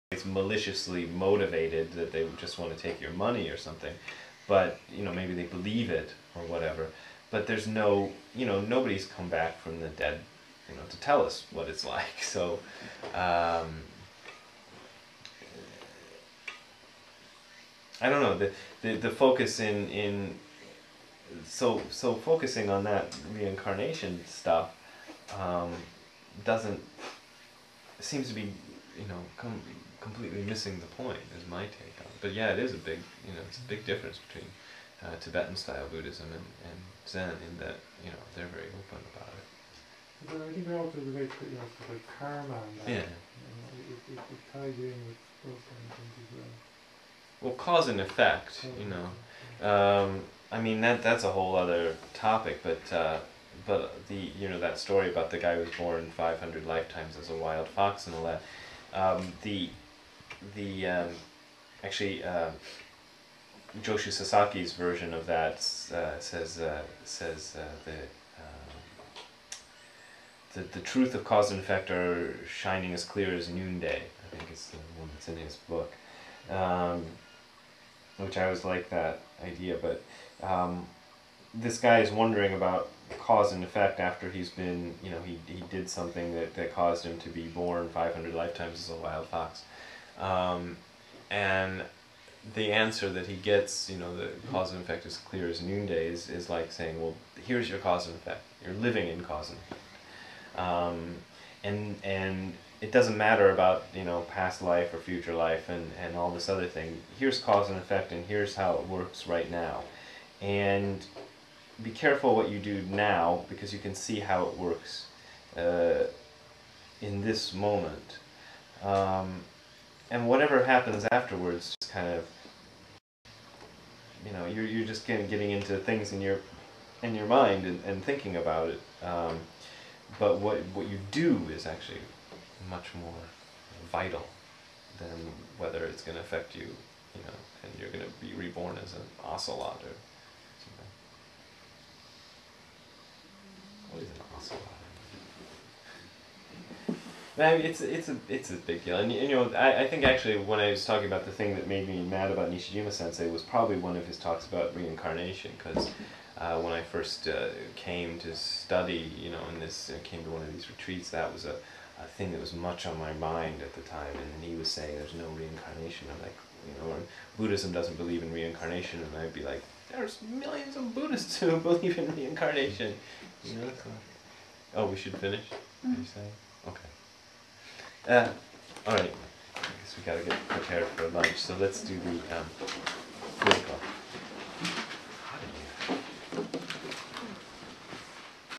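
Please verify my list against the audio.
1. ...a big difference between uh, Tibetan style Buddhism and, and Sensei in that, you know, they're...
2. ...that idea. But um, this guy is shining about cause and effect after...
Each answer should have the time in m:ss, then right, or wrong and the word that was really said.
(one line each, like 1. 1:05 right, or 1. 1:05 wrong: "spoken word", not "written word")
1. 0:33 wrong: "Zen", not "Sensei"
2. 1:18 wrong: "wondering", not "shining".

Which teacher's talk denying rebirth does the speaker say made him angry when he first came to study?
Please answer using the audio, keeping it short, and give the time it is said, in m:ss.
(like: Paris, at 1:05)
Nishijima Sensei, at 2:32.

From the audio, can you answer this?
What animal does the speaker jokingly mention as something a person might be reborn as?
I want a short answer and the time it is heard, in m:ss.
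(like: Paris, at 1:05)
Ocelot, at 2:19.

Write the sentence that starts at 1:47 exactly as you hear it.
Here's cause and effect, and here's how it works right now.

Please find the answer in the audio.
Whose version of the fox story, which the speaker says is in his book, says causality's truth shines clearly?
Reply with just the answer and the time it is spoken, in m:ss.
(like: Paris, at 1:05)
Sasaki, at 1:03.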